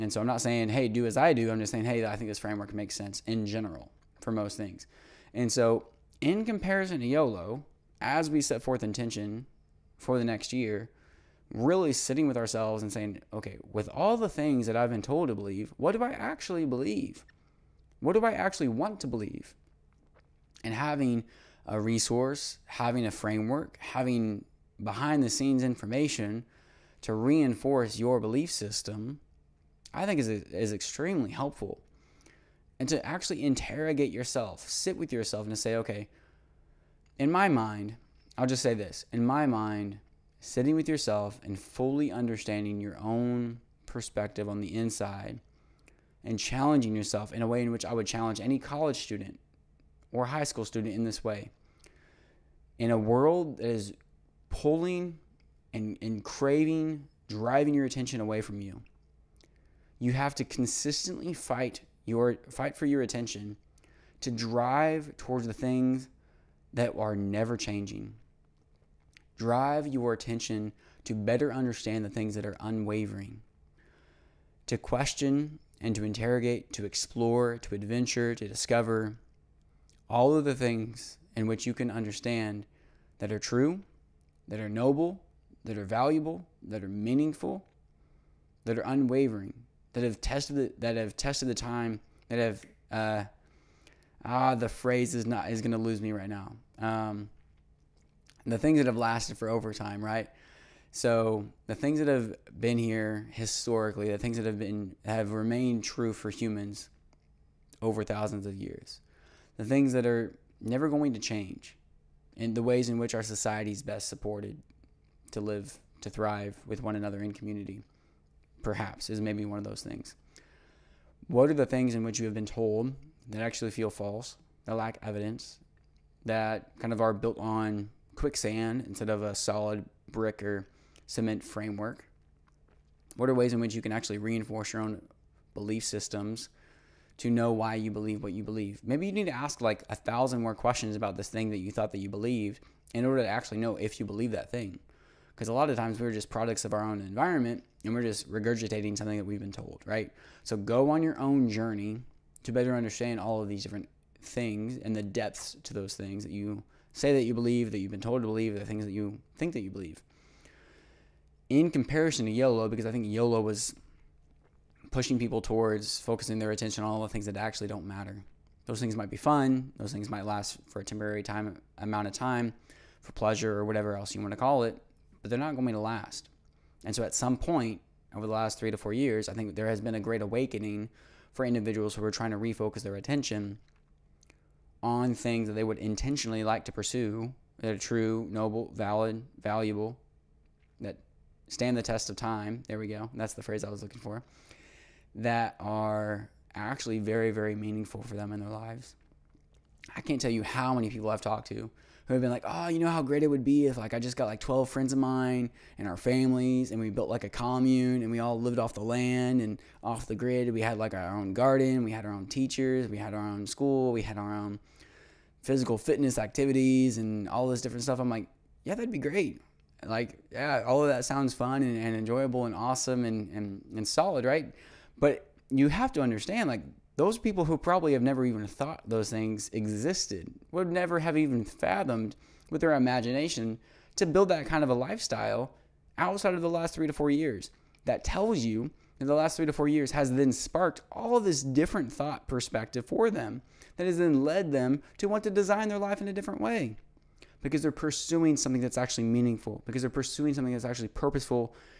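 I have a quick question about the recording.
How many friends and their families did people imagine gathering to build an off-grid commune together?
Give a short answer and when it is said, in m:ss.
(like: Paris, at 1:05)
12, at 3:24.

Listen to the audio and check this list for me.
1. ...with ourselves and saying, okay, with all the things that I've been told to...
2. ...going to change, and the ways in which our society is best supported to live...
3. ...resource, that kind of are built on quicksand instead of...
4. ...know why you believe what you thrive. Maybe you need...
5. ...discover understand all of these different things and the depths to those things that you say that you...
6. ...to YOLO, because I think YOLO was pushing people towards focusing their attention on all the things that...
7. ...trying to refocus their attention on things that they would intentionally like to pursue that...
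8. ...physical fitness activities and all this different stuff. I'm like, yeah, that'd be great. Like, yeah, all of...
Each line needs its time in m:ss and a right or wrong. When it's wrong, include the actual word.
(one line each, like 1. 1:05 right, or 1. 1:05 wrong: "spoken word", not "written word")
1. 0:12 right
2. 1:50 right
3. 2:05 wrong: "evidence", not "resource"
4. 2:17 wrong: "believe", not "thrive"
5. 2:32 wrong: "better", not "discover"
6. 2:42 right
7. 3:02 right
8. 3:35 right.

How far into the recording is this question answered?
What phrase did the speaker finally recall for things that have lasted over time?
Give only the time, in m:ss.
3:11.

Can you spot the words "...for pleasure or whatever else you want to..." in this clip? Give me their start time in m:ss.
2:53.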